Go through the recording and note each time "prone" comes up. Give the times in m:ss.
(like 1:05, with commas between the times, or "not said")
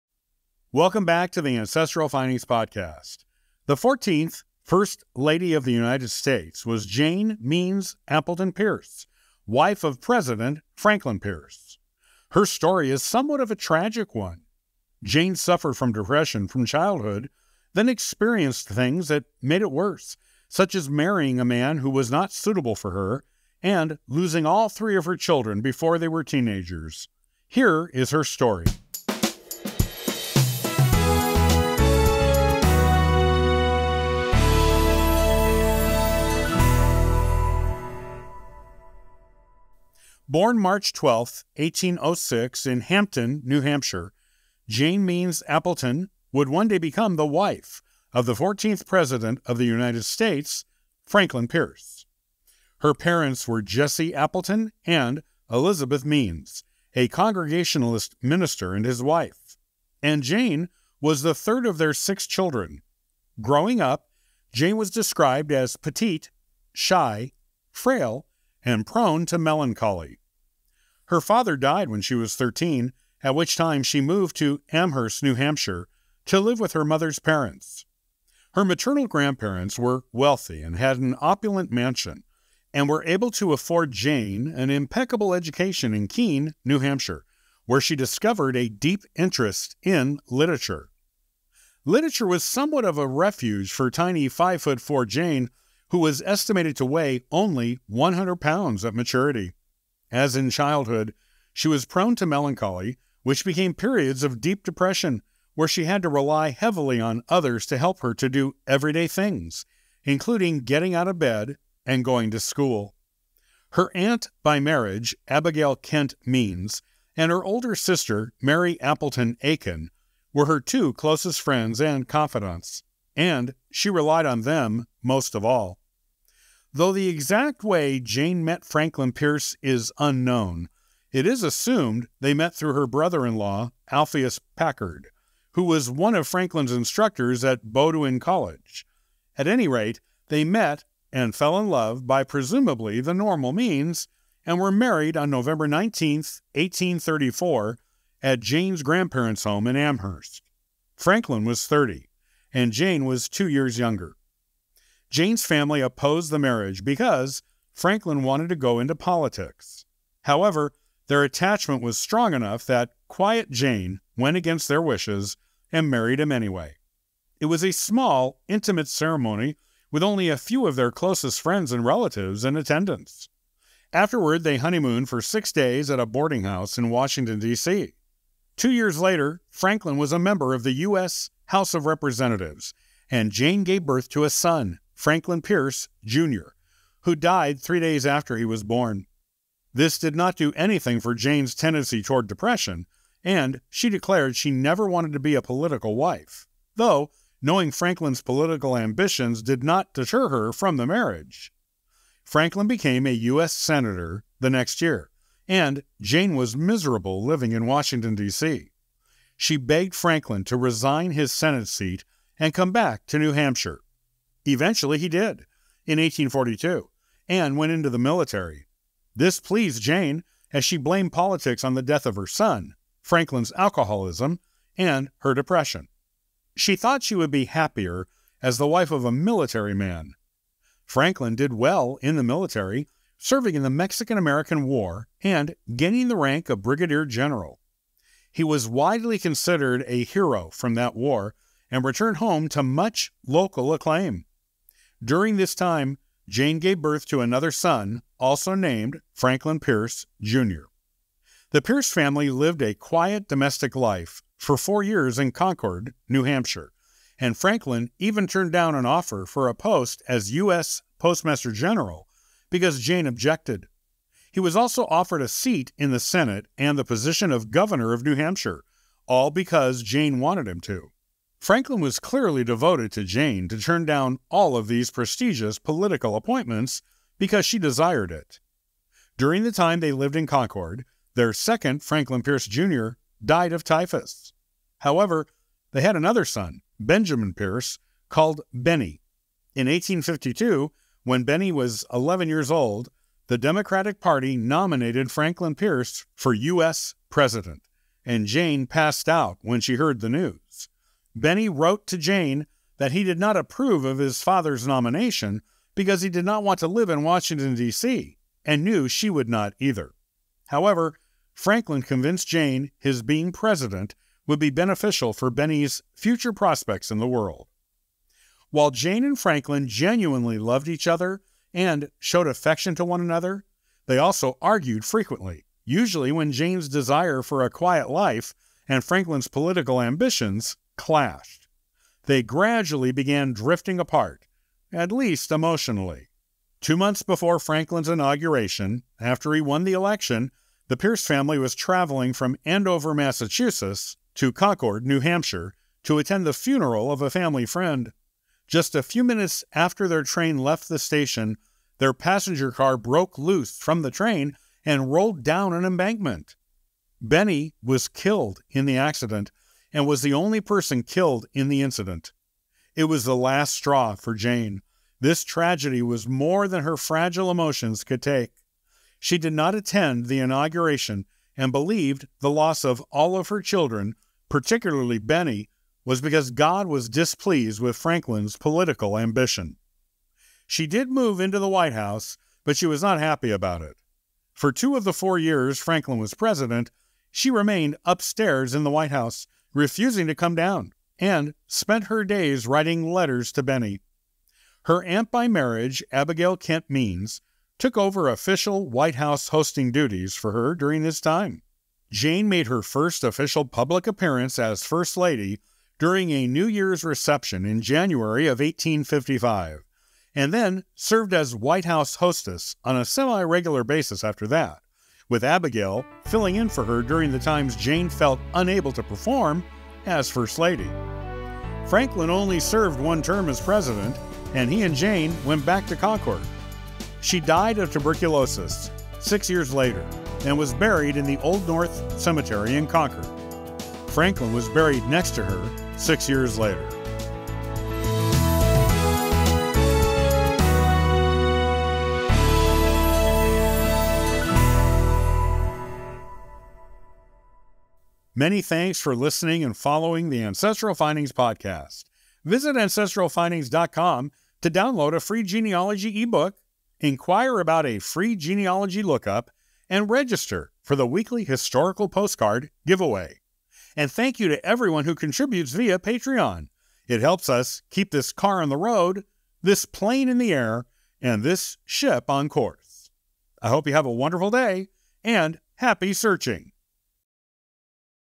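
1:08, 1:41.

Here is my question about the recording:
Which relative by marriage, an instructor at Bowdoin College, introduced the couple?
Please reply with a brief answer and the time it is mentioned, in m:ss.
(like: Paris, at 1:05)
Alpheus Packard, at 2:13.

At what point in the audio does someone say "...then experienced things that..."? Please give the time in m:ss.
0:17.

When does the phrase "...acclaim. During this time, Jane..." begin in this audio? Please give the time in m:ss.
4:03.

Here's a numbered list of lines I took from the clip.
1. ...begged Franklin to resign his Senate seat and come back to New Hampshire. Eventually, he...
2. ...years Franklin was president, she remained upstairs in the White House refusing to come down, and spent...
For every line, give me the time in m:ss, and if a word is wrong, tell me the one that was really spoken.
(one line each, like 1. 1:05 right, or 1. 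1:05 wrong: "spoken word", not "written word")
1. 3:29 right
2. 6:25 right.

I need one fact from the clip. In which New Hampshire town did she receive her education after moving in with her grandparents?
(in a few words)
Keene.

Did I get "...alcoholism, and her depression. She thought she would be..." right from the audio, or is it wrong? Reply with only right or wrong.
right.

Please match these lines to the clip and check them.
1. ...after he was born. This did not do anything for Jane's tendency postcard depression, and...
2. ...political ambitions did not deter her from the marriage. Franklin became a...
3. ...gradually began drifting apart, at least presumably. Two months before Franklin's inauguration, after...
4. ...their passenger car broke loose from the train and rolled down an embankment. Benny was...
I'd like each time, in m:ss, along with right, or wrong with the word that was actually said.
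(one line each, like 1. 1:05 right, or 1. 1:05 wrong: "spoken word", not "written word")
1. 3:08 wrong: "toward", not "postcard"
2. 3:18 right
3. 5:32 wrong: "emotionally", not "presumably"
4. 5:51 right.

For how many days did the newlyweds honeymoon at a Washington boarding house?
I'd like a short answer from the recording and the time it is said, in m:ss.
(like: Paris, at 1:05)
6, at 2:55.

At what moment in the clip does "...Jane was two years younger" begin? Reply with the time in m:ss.
2:32.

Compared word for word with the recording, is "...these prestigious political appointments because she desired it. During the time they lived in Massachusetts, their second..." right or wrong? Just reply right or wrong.
wrong.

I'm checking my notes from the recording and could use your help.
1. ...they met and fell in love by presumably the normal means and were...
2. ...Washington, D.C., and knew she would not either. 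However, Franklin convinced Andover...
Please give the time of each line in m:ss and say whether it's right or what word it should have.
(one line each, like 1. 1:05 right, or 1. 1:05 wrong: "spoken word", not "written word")
1. 2:20 right
2. 5:07 wrong: "Jane", not "Andover".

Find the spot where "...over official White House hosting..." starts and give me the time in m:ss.
6:37.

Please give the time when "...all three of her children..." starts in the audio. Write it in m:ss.
0:24.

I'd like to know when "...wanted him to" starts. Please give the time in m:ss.
4:30.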